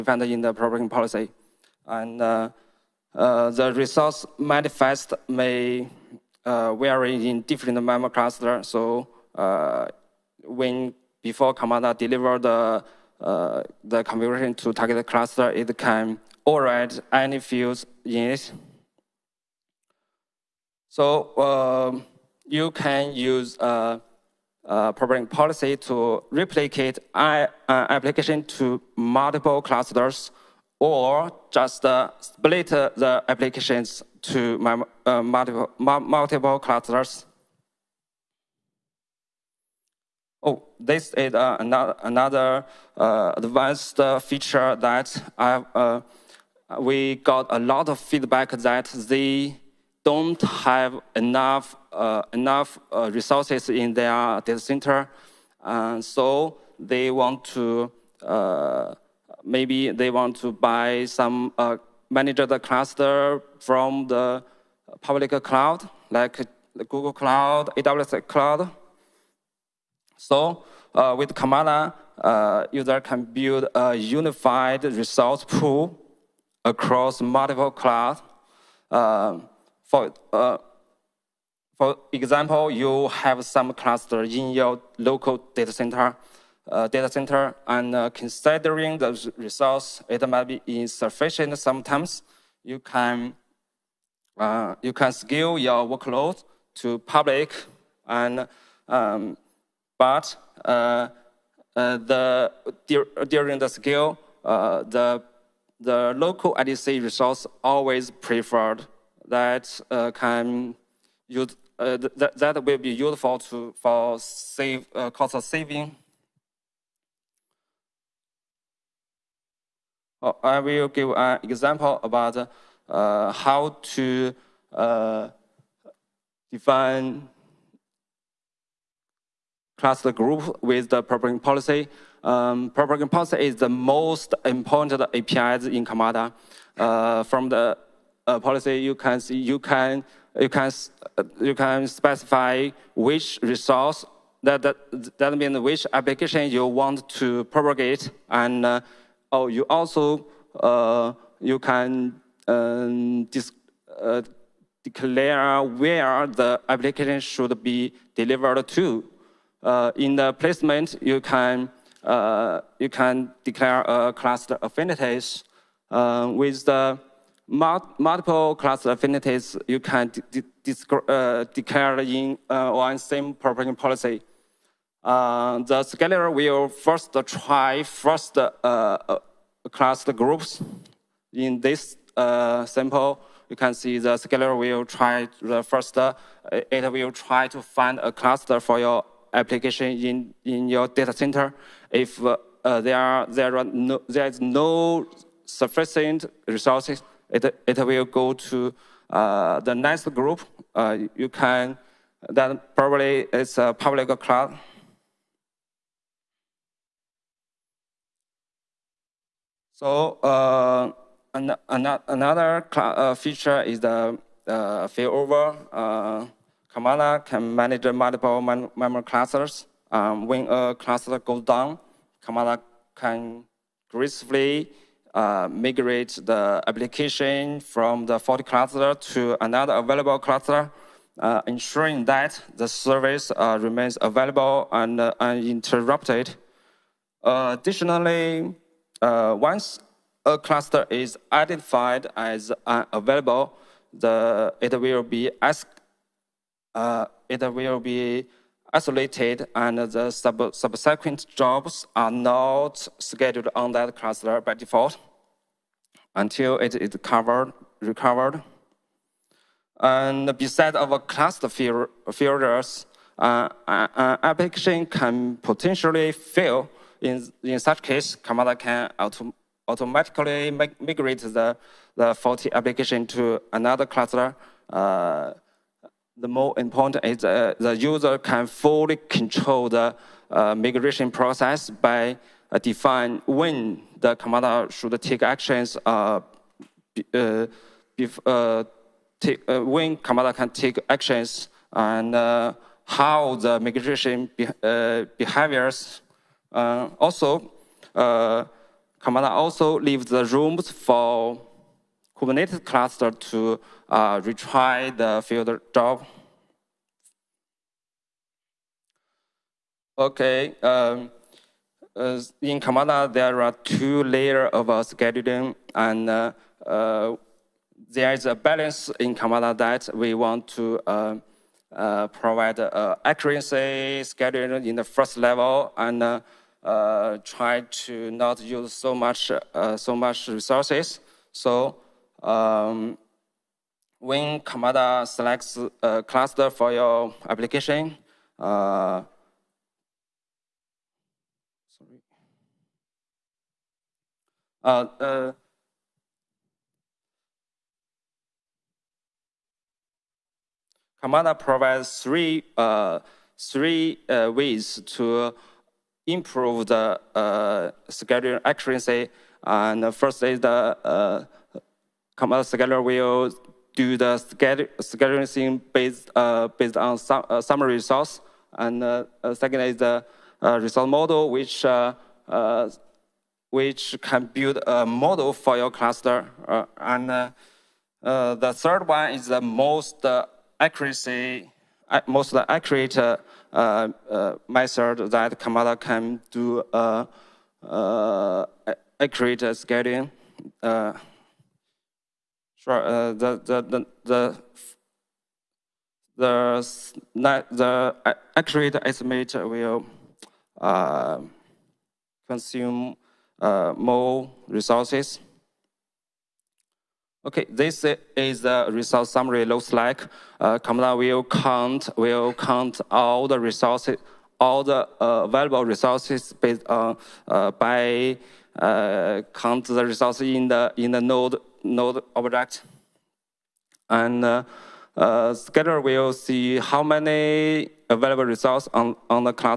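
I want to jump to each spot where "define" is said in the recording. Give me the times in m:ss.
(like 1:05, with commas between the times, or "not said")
2:06, 4:42.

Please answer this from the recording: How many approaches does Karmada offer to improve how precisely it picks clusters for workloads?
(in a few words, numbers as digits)
3.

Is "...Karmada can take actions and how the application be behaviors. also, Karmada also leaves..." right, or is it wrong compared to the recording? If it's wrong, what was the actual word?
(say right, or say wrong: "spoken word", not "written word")
wrong: "migration", not "application".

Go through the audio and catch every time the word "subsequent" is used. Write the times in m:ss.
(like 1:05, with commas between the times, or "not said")
4:10.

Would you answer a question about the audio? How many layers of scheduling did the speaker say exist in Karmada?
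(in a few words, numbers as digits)
2.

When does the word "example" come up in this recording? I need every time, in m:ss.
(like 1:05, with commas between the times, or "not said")
1:22, 2:01.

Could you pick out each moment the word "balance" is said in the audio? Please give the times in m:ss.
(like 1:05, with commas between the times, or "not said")
5:18.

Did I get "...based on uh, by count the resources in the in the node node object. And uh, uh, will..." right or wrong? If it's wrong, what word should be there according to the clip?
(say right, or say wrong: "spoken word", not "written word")
right.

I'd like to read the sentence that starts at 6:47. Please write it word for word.
Okay, this is the resource summary looks like.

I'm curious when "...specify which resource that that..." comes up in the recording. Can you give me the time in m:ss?
2:21.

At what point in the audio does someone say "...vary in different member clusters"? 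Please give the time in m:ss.
0:06.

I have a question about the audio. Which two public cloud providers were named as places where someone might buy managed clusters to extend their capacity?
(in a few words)
Google Cloud, AWS.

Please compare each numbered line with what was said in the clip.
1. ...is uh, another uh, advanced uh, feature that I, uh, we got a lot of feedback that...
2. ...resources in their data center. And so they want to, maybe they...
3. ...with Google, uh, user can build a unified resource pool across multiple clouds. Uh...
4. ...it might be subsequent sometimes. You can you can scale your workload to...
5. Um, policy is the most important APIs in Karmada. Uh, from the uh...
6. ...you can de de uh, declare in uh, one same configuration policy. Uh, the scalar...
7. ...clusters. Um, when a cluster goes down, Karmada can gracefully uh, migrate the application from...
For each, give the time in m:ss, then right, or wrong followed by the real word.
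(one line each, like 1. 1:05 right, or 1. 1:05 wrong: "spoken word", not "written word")
1. 0:41 right
2. 0:53 right
3. 1:11 wrong: "Karmada", not "Google"
4. 1:30 wrong: "insufficient", not "subsequent"
5. 2:12 right
6. 2:49 wrong: "propagation", not "configuration"
7. 3:39 right.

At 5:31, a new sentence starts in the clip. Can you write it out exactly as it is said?
So um, when Karmada selects a uh, cluster for your application, uh, sorry.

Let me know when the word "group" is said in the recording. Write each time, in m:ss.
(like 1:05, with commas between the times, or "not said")
2:10, 3:00, 3:20.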